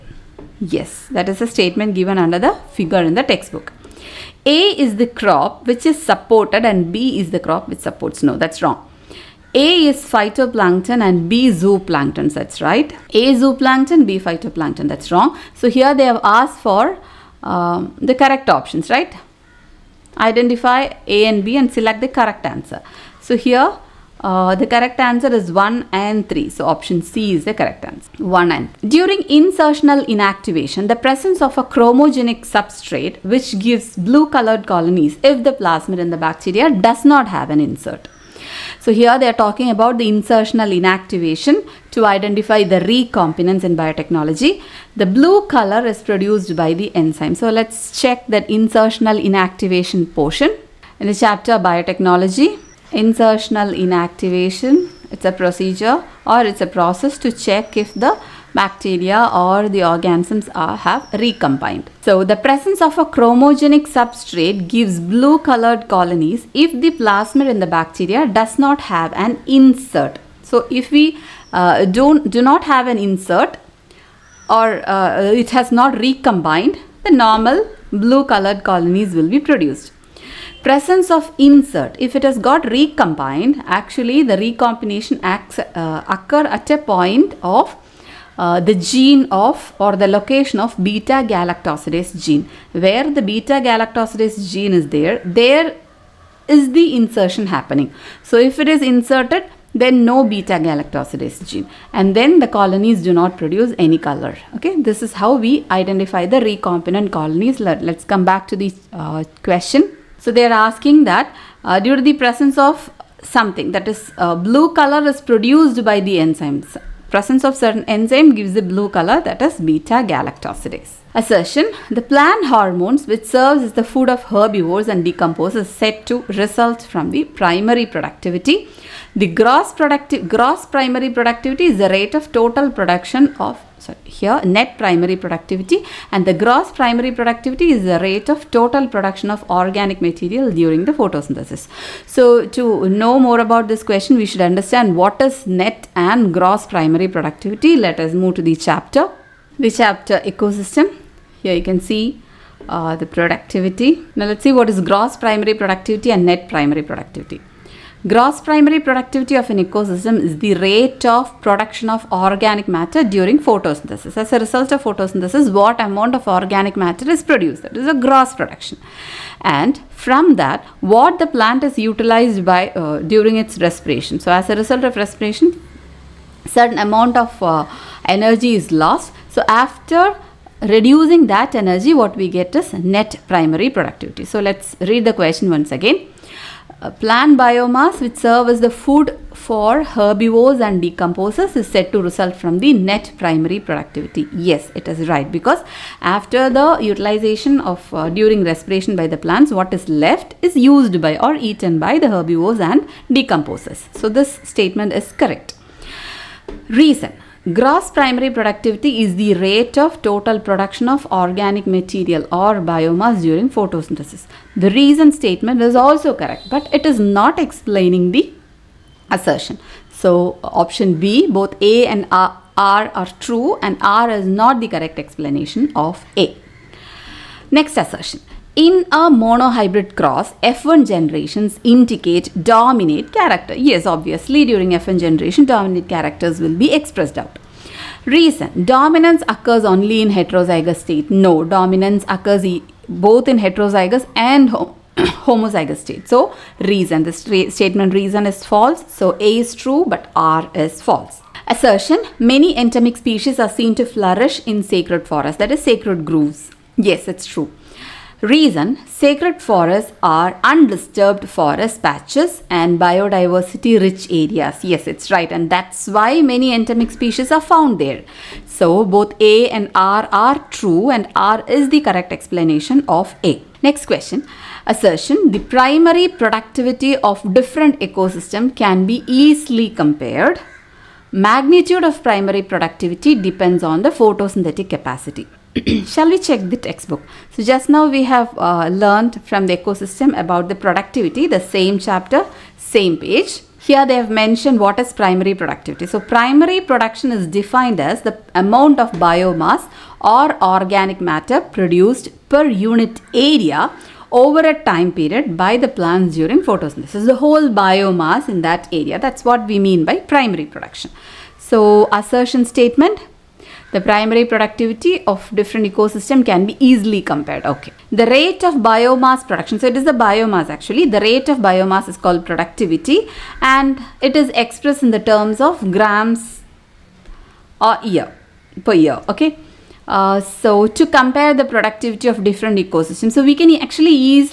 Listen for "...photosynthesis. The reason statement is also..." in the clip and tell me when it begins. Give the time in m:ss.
3:33.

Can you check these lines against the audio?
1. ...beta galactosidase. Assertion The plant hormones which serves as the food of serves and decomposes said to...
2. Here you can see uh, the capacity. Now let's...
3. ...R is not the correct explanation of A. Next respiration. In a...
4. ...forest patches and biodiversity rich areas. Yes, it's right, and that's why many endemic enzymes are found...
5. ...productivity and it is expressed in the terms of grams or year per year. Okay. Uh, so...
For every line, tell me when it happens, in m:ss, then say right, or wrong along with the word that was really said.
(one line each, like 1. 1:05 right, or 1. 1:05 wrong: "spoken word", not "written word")
1. 1:59 wrong: "herbivores", not "serves"
2. 2:31 wrong: "productivity", not "capacity"
3. 3:43 wrong: "assertion", not "respiration"
4. 4:21 wrong: "species", not "enzymes"
5. 5:22 right.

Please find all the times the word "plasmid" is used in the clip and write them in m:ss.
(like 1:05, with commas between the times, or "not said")
0:35, 1:06.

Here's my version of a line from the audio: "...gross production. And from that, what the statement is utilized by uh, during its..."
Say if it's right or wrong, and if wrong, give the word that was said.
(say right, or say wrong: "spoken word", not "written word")
wrong: "plant", not "statement".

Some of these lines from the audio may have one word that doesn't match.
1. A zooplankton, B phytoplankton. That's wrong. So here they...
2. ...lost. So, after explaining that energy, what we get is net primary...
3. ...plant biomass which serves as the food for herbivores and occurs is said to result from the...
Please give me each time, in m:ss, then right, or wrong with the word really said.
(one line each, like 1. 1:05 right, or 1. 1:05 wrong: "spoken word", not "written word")
1. 0:13 right
2. 2:58 wrong: "reducing", not "explaining"
3. 3:06 wrong: "decomposers", not "occurs".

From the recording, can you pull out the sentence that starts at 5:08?
That's what we mean by primary production.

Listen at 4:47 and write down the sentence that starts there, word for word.
So just now we have uh, learned from the ecosystem about the productivity, the same chapter, same page.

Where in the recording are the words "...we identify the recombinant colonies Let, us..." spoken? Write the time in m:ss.
1:45.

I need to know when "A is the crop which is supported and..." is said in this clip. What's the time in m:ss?
0:04.